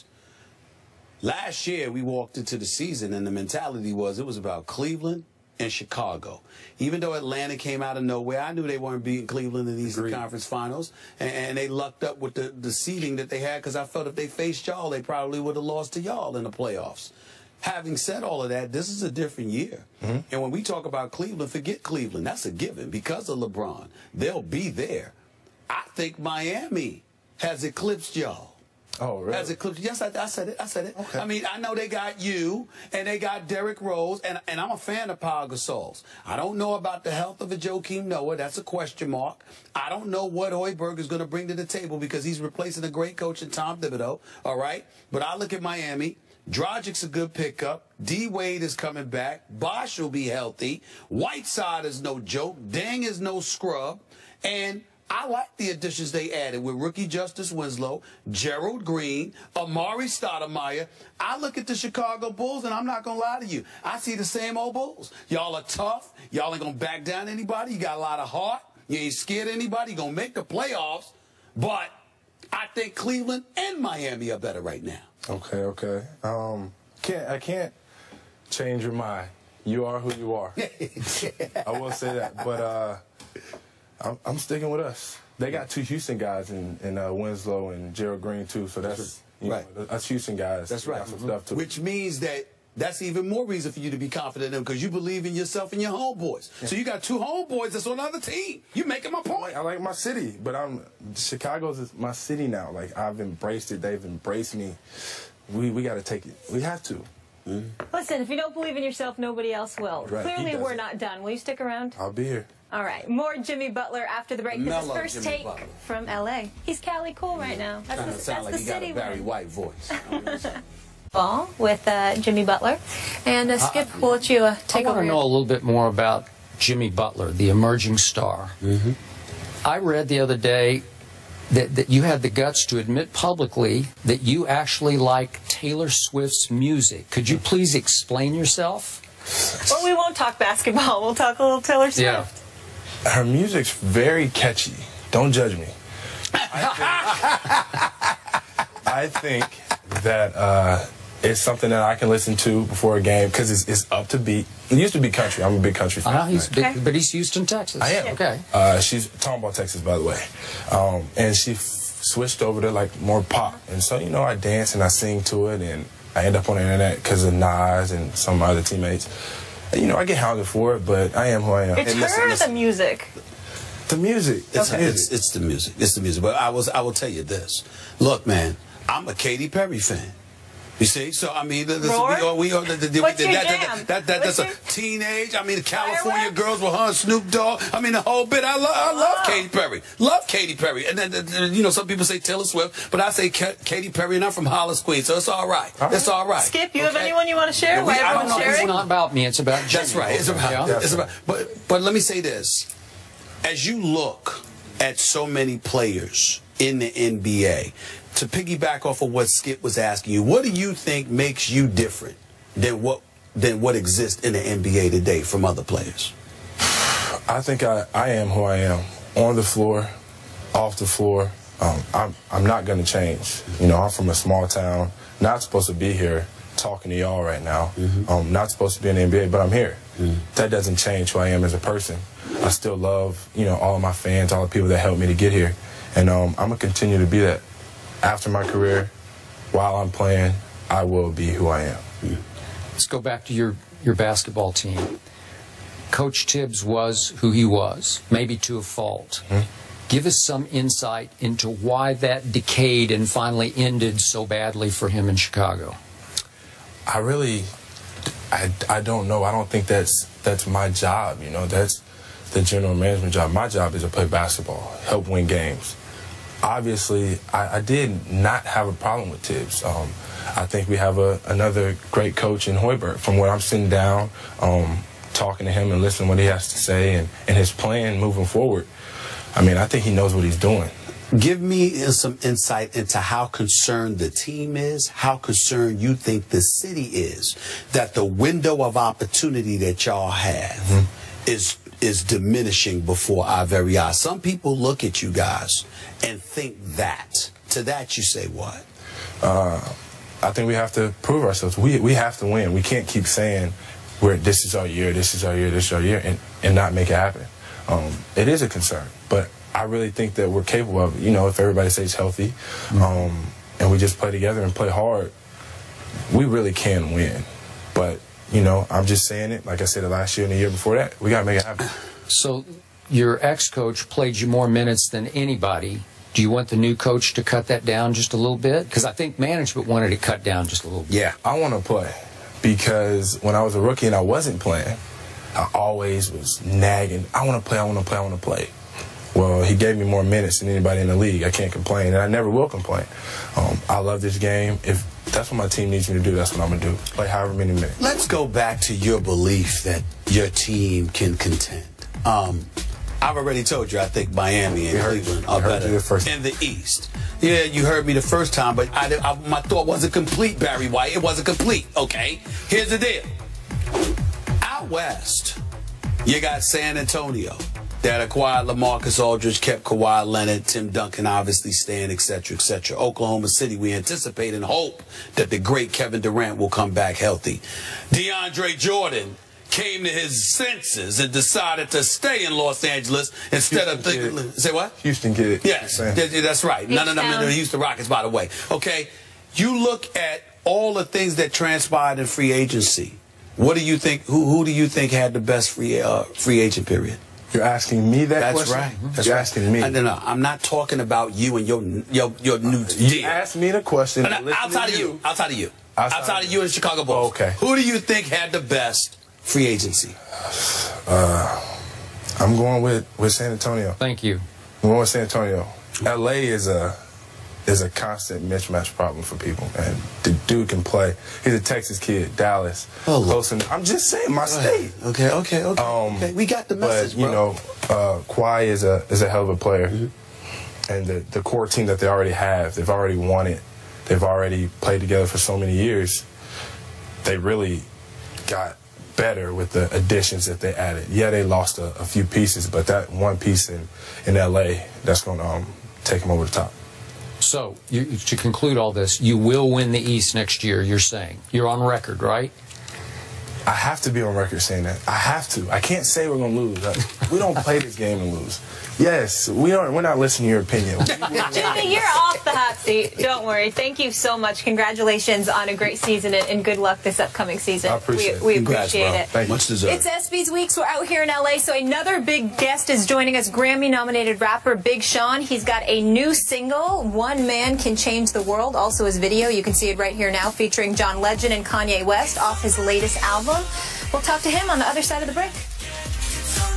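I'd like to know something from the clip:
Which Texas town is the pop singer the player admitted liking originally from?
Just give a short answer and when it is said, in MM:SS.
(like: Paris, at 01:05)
Tomball, at 02:39.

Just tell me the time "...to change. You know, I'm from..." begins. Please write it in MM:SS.
03:42.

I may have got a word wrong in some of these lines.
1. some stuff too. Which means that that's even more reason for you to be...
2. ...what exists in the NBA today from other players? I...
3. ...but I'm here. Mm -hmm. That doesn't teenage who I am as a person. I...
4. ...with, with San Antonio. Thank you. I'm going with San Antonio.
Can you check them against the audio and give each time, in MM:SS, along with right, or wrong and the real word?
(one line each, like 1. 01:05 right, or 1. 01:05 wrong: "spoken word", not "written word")
1. 01:31 right
2. 03:33 right
3. 03:49 wrong: "change", not "teenage"
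4. 06:52 right.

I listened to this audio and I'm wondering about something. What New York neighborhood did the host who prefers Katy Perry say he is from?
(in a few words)
Hollis, Queens.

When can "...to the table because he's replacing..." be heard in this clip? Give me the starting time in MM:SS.
00:41.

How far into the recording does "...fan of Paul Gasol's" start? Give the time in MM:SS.
00:34.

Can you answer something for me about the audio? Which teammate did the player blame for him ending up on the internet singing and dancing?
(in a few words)
Nas.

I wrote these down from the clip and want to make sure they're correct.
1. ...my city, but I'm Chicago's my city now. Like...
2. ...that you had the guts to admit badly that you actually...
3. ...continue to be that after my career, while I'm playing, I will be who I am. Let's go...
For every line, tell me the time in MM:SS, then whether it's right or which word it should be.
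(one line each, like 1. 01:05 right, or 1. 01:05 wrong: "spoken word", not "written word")
1. 01:39 right
2. 02:11 wrong: "publicly", not "badly"
3. 03:56 right.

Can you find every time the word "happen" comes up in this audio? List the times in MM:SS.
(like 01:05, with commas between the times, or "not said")
05:06, 05:21.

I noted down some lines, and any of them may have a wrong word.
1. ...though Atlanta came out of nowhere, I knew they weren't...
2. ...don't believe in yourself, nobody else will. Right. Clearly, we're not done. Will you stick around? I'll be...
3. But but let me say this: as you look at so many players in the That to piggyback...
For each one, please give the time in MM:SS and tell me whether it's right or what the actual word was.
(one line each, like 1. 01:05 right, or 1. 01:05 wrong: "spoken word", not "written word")
1. 00:06 right
2. 01:48 right
3. 03:21 wrong: "NBA", not "That".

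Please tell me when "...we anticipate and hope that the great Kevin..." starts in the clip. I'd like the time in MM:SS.
06:13.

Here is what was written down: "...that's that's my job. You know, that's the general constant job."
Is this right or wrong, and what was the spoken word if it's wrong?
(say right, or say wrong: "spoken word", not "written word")
wrong: "management", not "constant".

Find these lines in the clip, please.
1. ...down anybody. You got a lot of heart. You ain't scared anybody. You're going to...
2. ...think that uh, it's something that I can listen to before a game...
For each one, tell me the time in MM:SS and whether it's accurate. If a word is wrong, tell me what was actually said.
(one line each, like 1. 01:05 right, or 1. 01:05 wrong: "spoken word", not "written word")
1. 01:07 right
2. 02:29 right.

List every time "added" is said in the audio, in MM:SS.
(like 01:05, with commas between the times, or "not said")
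00:56, 07:20.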